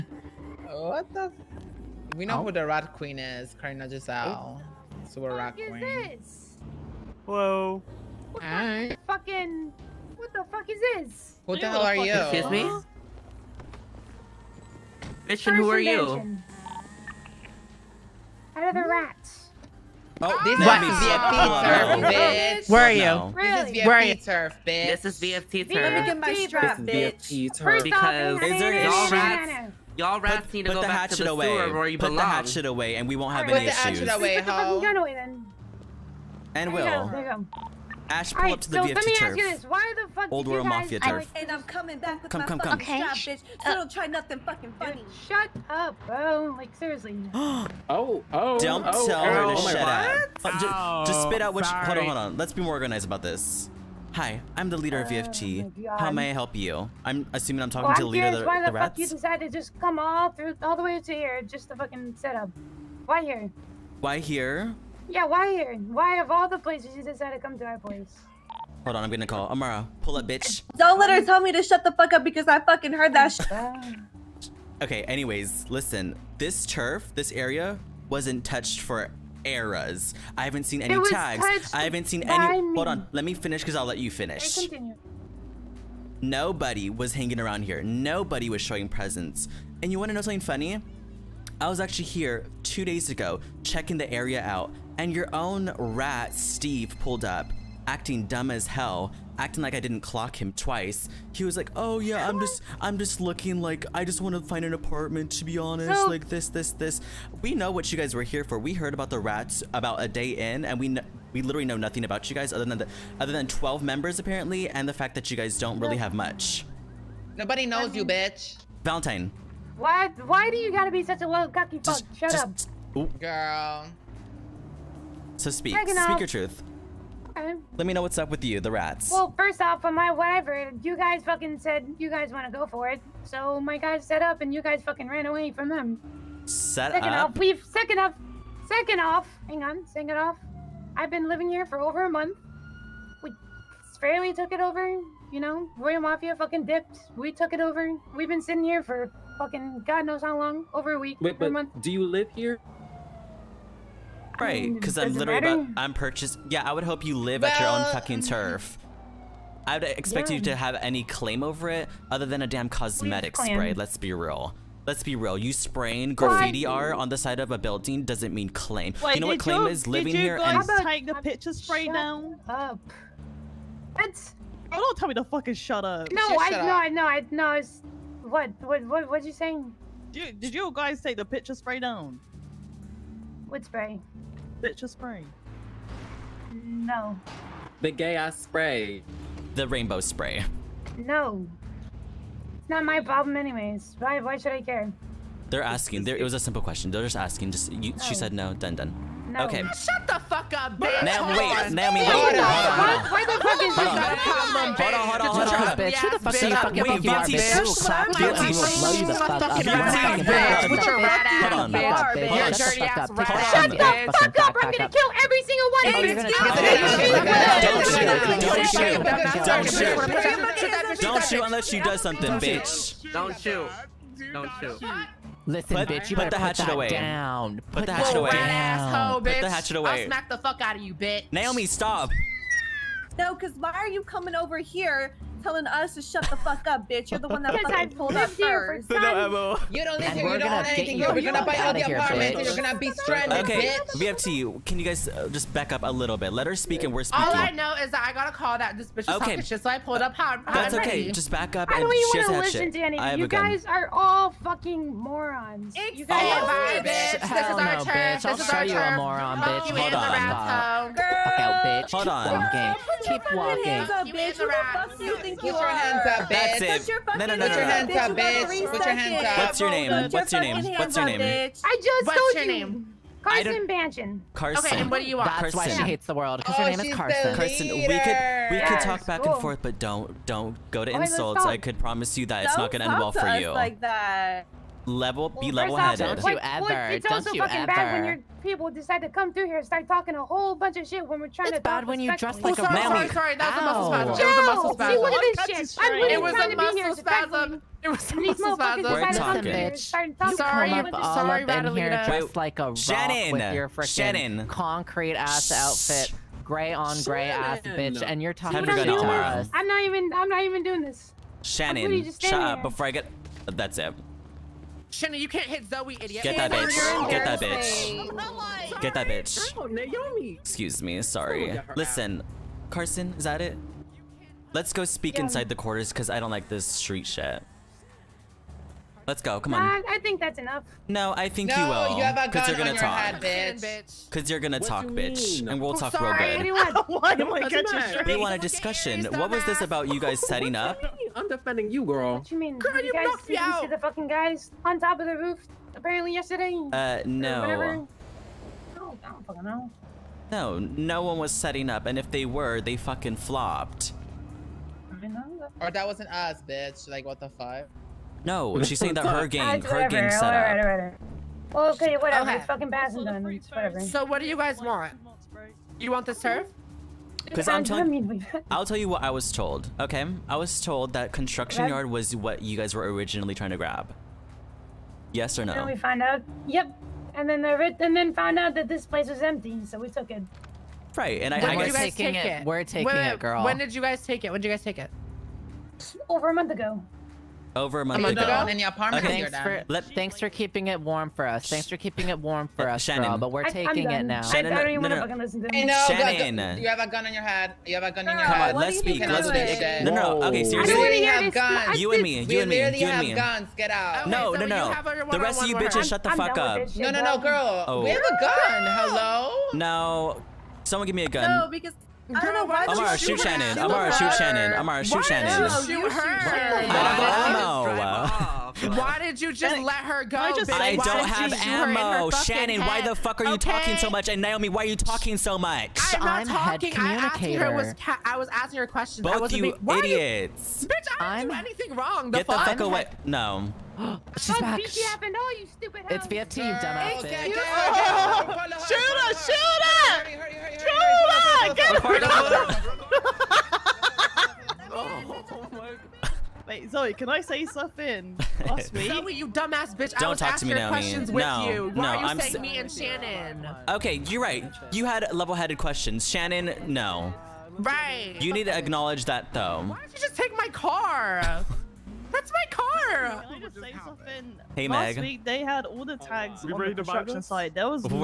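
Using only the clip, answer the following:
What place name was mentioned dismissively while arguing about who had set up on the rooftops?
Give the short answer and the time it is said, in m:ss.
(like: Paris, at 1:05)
Basildon, at 6:02.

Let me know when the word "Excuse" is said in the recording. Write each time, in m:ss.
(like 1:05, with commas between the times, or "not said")
0:12, 5:20.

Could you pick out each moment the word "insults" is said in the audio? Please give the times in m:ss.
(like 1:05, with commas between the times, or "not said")
4:41.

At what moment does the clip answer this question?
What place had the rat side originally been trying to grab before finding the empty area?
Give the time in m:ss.
6:11.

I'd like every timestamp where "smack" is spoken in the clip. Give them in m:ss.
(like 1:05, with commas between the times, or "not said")
3:50.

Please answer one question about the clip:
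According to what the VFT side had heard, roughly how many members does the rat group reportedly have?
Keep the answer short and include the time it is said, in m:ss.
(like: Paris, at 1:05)
12, at 1:53.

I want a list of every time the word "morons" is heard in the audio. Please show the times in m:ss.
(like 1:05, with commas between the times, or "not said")
4:14, 4:18.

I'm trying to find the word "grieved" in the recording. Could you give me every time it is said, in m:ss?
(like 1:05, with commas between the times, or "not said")
not said.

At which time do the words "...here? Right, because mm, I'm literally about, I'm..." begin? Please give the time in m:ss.
2:32.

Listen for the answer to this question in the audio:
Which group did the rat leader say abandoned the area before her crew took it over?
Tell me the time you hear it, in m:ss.
2:25.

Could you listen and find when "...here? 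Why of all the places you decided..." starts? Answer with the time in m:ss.
1:05.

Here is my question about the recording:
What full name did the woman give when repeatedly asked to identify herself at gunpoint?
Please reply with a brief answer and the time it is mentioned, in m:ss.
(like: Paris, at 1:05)
Carson Banjan, at 4:33.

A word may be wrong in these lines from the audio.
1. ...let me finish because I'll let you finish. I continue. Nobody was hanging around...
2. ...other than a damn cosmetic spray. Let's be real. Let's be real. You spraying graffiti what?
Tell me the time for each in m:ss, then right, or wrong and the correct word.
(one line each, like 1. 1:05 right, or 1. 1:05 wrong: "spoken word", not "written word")
1. 1:23 right
2. 2:42 right.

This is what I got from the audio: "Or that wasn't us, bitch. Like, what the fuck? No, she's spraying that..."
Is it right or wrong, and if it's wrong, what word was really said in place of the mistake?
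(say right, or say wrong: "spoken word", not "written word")
wrong: "saying", not "spraying".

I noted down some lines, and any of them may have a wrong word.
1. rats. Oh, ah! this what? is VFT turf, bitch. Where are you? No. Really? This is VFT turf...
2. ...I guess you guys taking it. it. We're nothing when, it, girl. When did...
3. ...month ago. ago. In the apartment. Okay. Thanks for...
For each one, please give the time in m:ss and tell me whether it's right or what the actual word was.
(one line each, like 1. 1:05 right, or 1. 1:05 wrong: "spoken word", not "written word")
1. 0:18 right
2. 6:21 wrong: "taking", not "nothing"
3. 6:28 right.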